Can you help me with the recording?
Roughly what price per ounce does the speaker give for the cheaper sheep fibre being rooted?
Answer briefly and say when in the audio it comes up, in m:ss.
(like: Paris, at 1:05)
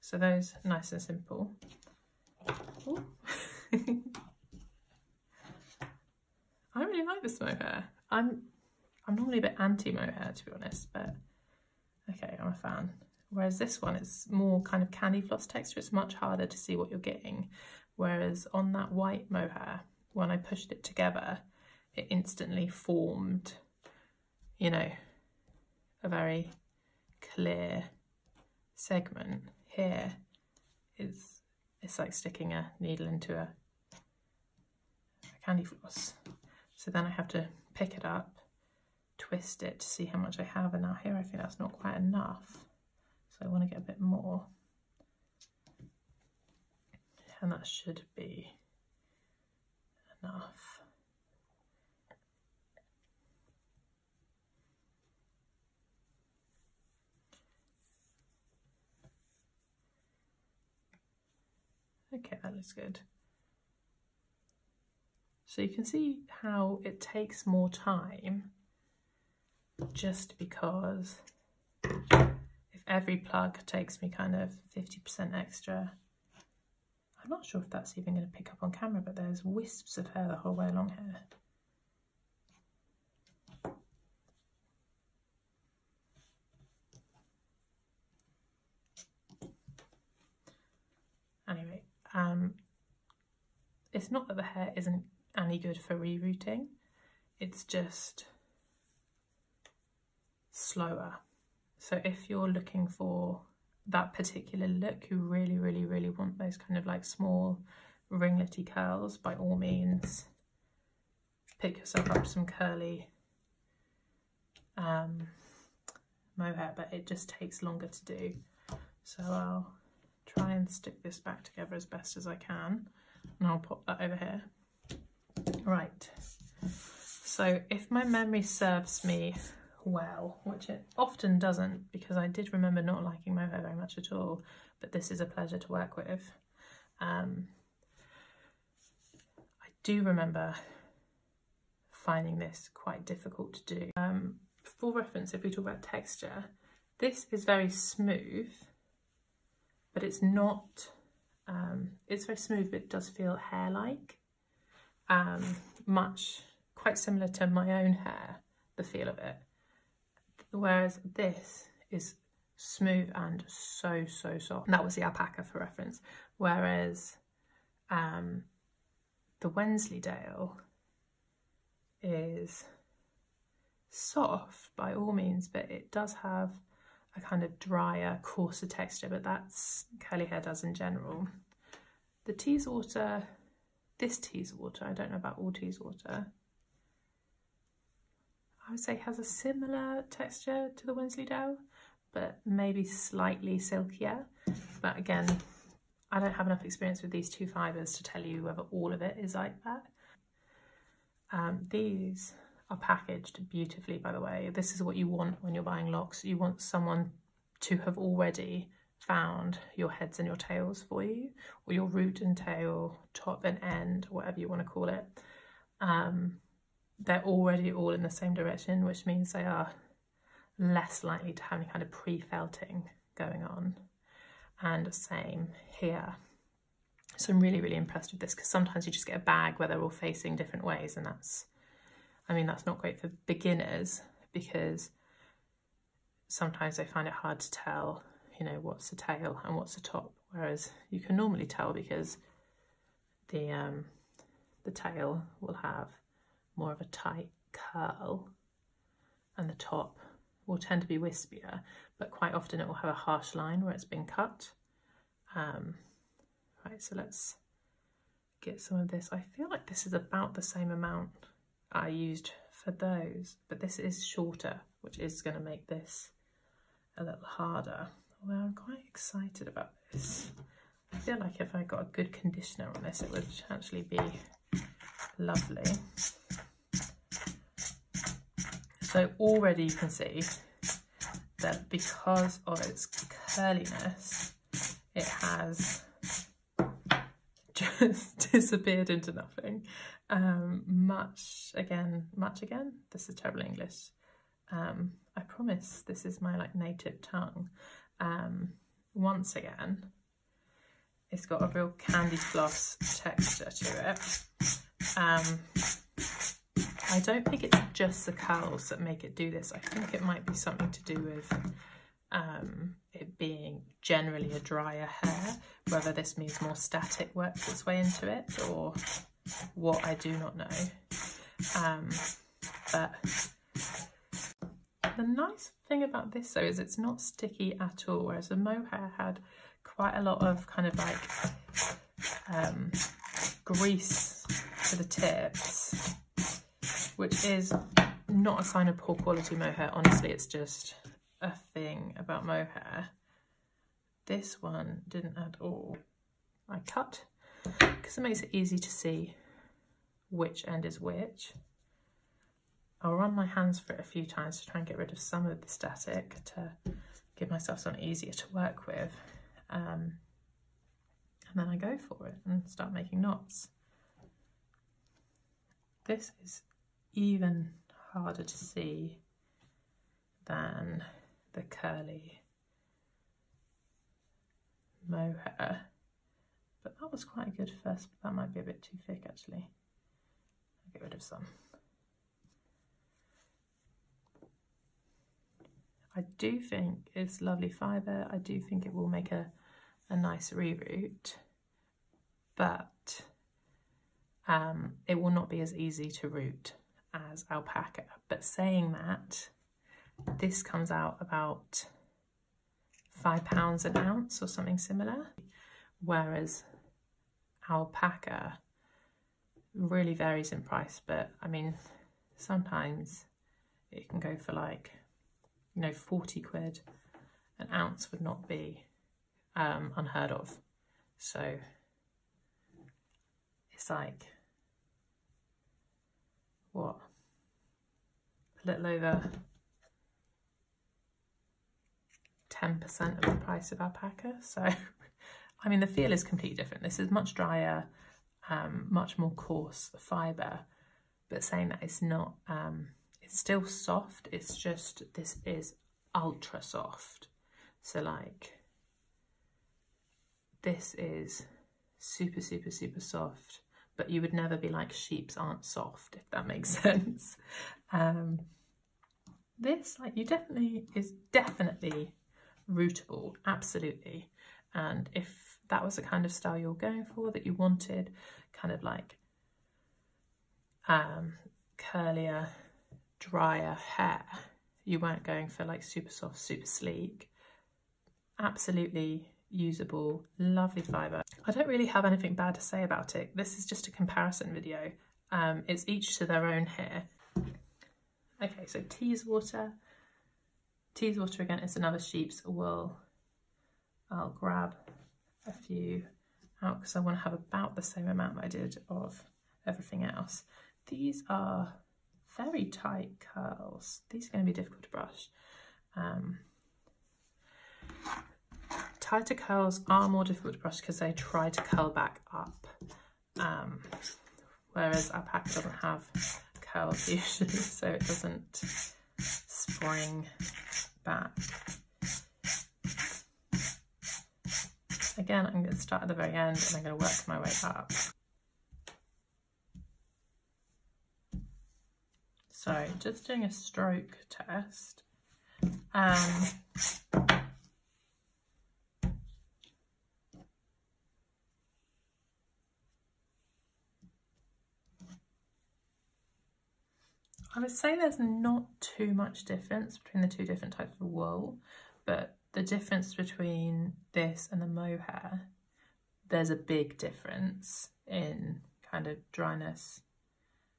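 5 pounds, at 6:42.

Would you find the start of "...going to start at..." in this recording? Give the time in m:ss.
8:45.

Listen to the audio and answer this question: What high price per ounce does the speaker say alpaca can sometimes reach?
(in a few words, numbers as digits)
40 quid.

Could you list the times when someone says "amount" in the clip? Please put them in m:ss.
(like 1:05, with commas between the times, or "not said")
4:20, 8:17.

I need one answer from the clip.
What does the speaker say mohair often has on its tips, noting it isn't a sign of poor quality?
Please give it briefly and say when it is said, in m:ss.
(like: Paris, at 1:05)
grease, at 5:33.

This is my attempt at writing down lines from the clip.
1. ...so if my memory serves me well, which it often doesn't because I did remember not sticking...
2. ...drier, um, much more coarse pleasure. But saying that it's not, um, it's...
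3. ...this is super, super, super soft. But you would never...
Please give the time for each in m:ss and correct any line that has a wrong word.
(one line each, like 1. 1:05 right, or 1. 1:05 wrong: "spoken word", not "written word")
1. 2:07 wrong: "liking", not "sticking"
2. 7:17 wrong: "fibre", not "pleasure"
3. 7:30 right.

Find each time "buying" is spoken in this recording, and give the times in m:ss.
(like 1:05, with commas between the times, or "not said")
3:25.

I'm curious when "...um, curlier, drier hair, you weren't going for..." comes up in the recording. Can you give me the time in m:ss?
7:50.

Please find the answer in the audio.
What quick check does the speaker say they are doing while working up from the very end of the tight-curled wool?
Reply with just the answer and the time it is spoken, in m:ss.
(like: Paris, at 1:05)
stroke test, at 8:53.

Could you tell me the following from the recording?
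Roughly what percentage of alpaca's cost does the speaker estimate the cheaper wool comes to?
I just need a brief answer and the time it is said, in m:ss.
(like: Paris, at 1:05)
a little over 10%, at 7:12.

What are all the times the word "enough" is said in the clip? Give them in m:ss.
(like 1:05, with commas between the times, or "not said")
0:41, 0:50, 3:16.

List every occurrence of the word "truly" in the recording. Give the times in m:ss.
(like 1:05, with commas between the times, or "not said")
not said.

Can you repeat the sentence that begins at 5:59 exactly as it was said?
Um, and then I go for it and start making knots.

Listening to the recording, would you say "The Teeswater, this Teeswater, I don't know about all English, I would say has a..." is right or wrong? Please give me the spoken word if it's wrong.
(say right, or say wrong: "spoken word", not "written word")
wrong: "Teeswater", not "English".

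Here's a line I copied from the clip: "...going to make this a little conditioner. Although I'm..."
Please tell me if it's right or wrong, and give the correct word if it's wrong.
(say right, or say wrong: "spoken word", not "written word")
wrong: "harder", not "conditioner".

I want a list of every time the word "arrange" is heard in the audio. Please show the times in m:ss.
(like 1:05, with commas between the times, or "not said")
not said.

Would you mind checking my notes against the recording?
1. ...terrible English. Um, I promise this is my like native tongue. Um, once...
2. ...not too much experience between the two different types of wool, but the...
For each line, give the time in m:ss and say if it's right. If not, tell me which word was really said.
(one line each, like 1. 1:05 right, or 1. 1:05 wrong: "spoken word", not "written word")
1. 4:53 right
2. 9:07 wrong: "difference", not "experience".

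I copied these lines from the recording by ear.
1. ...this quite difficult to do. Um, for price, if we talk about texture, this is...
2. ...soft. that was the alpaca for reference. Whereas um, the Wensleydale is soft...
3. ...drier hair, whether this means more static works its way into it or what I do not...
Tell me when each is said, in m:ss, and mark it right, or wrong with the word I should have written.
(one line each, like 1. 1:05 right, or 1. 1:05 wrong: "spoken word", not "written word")
1. 2:22 wrong: "reference", not "price"
2. 2:44 right
3. 5:14 right.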